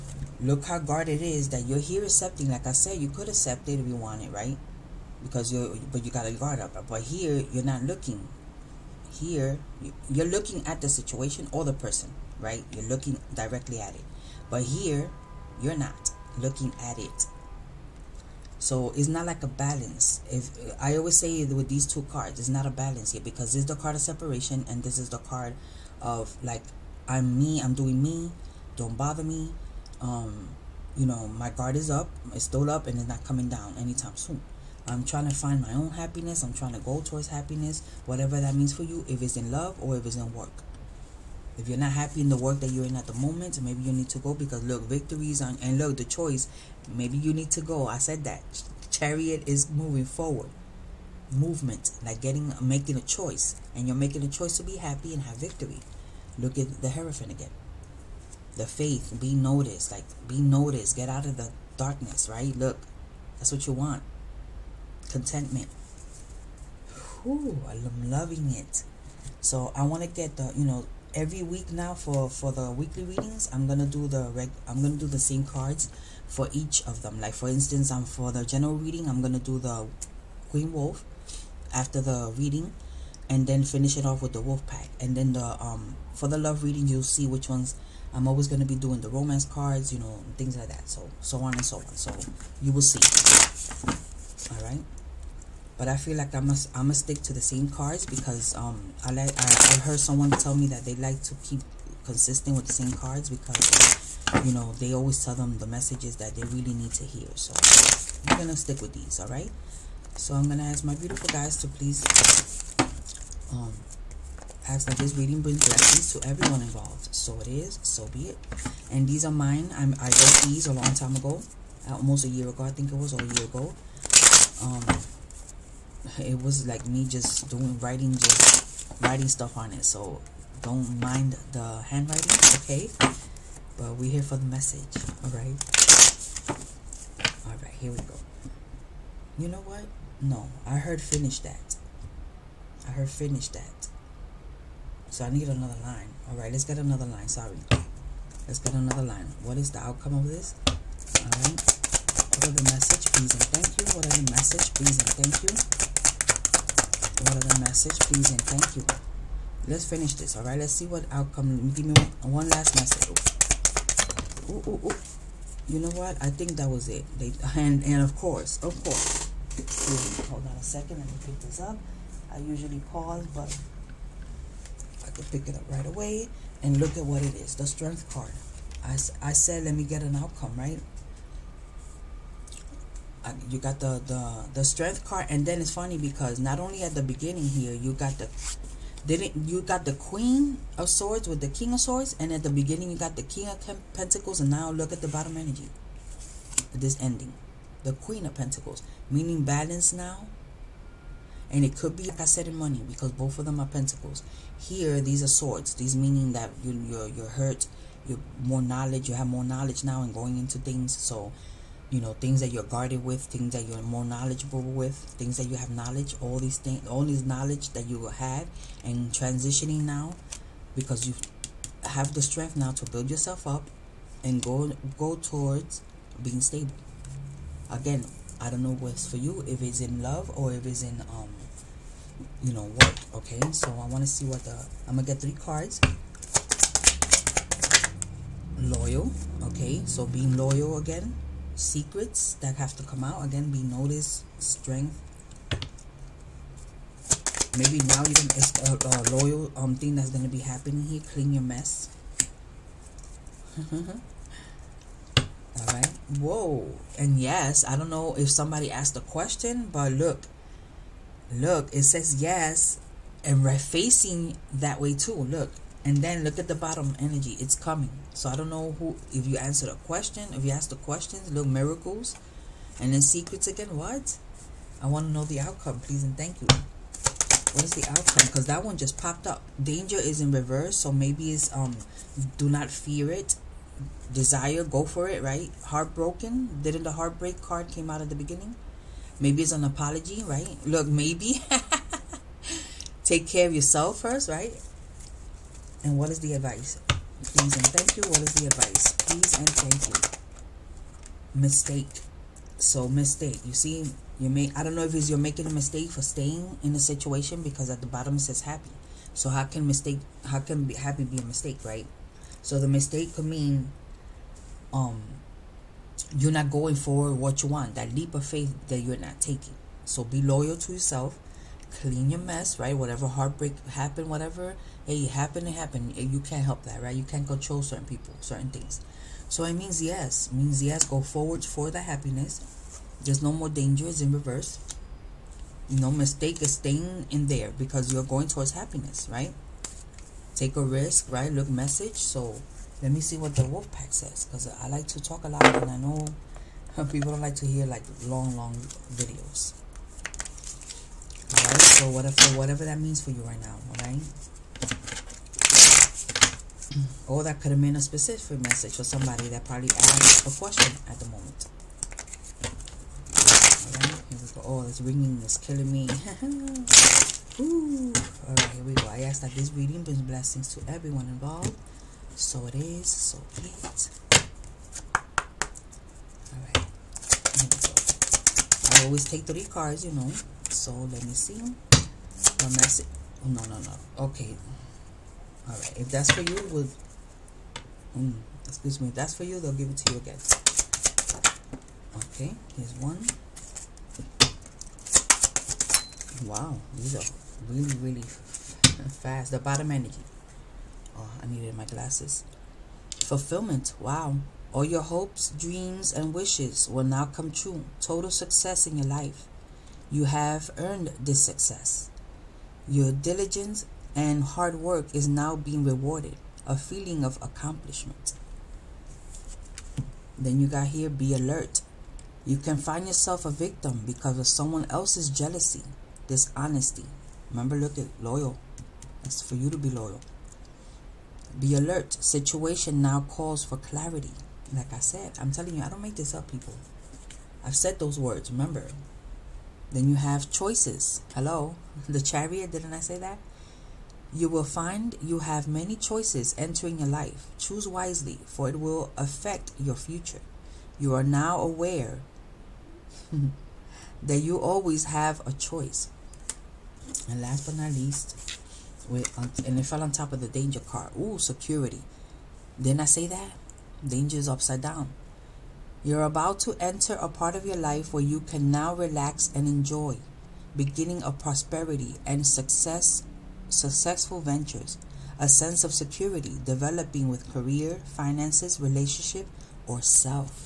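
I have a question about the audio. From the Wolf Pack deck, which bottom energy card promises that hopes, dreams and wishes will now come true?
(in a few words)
Fulfillment.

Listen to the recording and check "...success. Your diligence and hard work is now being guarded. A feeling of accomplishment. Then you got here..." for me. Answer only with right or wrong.
wrong.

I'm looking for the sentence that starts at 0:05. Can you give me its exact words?
Because you are but you got to guard up.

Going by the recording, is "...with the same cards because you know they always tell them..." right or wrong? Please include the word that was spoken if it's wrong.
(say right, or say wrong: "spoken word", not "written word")
right.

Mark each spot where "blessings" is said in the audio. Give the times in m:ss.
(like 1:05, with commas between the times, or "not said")
1:55, 6:10.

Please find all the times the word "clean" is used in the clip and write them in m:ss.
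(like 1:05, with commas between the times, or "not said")
4:11, 5:21.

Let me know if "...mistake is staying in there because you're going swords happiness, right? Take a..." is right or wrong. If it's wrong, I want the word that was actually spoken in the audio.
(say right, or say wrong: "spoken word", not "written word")
wrong: "towards", not "swords".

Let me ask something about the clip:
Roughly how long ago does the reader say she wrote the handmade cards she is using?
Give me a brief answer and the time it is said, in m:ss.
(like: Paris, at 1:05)
almost a year ago, at 2:01.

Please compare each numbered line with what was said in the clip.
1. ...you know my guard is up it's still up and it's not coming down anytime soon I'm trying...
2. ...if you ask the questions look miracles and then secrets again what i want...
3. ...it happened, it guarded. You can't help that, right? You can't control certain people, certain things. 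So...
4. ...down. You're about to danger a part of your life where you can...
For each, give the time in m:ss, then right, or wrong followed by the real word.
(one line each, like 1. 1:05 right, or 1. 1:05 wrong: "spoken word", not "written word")
1. 0:30 right
2. 4:30 right
3. 5:25 wrong: "happened", not "guarded"
4. 7:44 wrong: "enter", not "danger".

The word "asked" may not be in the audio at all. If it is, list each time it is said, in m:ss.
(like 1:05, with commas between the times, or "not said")
4:18, 5:59.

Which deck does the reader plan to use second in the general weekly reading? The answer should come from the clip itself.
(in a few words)
Queen Wolf.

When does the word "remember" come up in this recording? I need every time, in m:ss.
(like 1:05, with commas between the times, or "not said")
7:07, 7:18.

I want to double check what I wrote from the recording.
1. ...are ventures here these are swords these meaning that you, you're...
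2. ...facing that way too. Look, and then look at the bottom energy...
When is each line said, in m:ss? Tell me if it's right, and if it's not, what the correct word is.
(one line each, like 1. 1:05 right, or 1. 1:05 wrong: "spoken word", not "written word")
1. 3:23 wrong: "pentacles", not "ventures"
2. 4:23 right.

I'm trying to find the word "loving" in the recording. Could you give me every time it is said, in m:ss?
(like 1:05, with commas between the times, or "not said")
1:08.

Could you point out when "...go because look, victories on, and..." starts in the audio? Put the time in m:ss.
0:44.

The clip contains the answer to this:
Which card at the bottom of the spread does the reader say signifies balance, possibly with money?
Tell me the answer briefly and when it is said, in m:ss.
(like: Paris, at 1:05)
Queen of Pentacles, at 3:17.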